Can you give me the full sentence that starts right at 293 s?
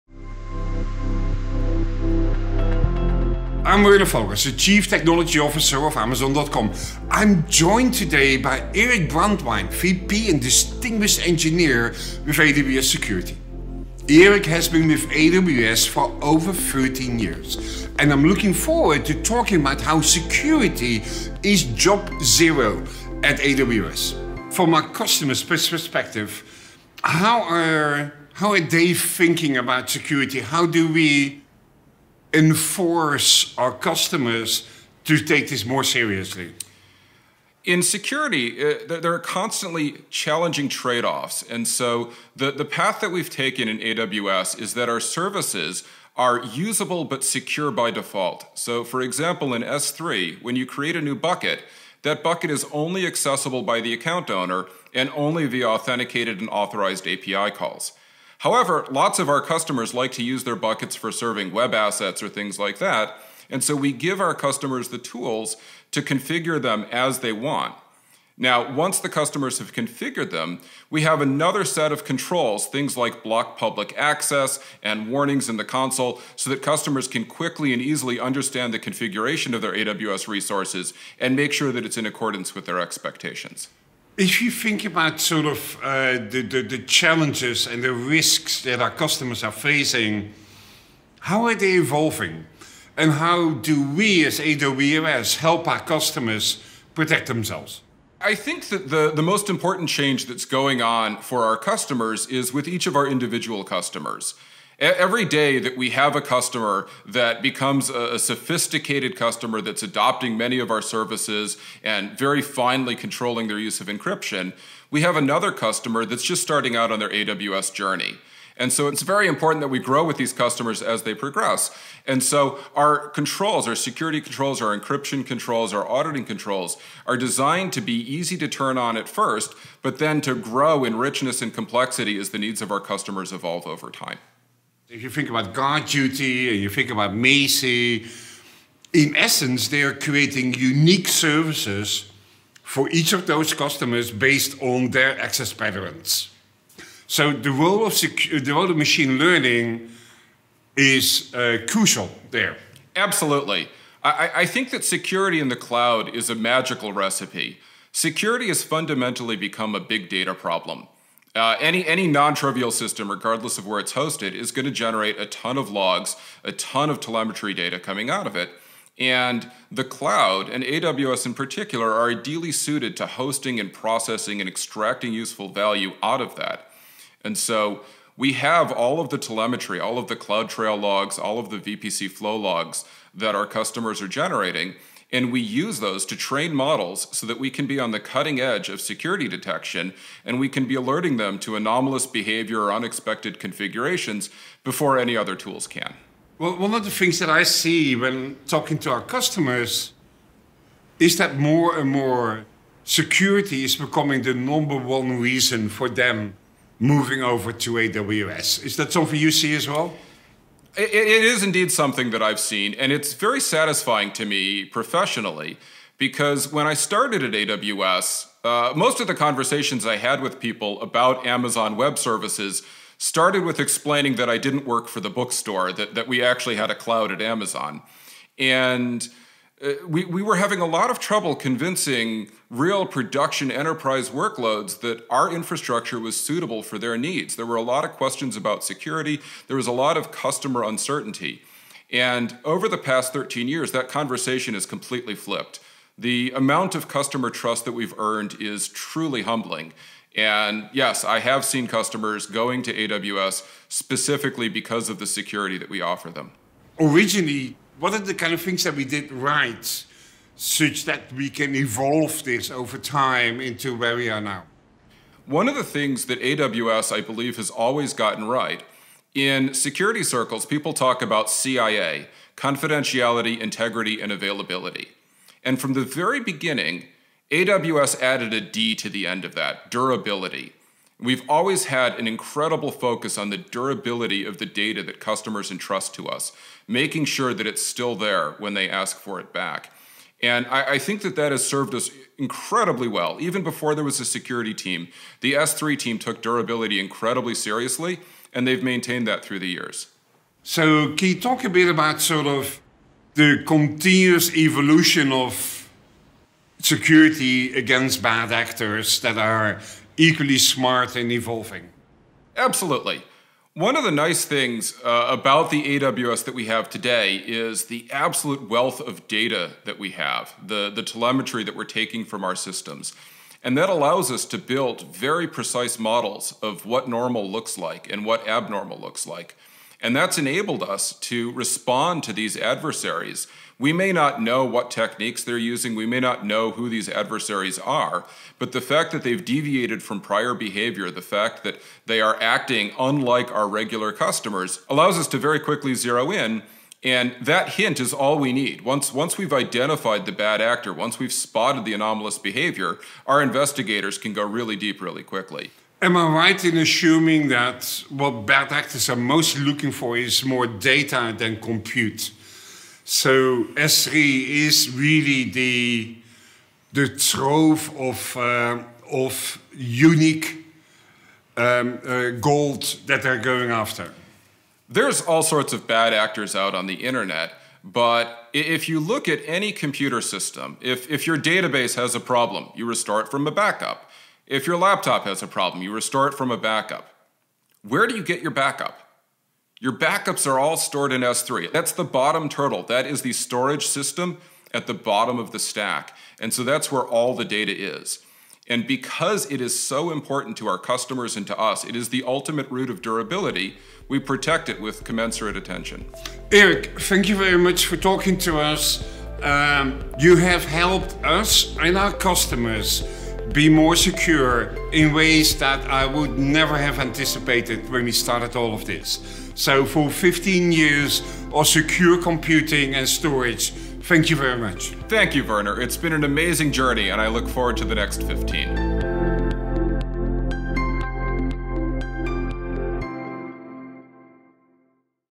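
Even before there was a security team, the S3 team took durability incredibly seriously, and they've maintained that through the years.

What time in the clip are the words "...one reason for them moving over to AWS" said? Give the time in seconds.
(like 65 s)
204 s.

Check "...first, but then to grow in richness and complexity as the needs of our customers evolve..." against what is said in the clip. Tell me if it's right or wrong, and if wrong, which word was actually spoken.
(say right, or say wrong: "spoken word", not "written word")
right.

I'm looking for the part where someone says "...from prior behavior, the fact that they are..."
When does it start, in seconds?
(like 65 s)
339 s.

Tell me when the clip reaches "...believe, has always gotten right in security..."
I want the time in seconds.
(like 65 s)
267 s.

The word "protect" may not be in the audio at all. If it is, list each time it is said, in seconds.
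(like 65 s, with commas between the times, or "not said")
96 s, 403 s.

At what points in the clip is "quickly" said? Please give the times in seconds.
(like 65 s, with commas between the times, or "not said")
77 s, 345 s, 355 s.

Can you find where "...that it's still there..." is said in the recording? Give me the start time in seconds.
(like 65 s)
287 s.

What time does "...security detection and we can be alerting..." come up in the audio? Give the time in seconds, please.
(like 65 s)
188 s.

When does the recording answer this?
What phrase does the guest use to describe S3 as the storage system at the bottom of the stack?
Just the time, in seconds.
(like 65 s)
391 s.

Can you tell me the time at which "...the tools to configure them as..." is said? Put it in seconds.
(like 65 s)
64 s.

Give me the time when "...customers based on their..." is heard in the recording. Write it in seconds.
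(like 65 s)
143 s.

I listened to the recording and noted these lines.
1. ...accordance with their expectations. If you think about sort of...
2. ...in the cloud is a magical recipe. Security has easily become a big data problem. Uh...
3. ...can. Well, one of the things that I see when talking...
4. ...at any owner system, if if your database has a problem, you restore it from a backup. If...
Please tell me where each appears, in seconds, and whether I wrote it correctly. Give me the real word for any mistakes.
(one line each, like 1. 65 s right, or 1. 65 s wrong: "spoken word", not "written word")
1. 82 s right
2. 155 s wrong: "fundamentally", not "easily"
3. 195 s right
4. 379 s wrong: "computer", not "owner".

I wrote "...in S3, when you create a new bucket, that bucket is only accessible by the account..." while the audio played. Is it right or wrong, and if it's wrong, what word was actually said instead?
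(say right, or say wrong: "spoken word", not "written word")
right.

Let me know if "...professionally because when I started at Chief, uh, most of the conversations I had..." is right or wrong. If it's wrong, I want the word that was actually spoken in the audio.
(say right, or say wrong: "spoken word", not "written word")
wrong: "AWS", not "Chief".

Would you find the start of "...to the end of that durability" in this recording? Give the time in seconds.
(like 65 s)
278 s.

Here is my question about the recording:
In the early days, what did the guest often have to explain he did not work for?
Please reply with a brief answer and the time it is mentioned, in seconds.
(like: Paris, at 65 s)
the bookstore, at 224 s.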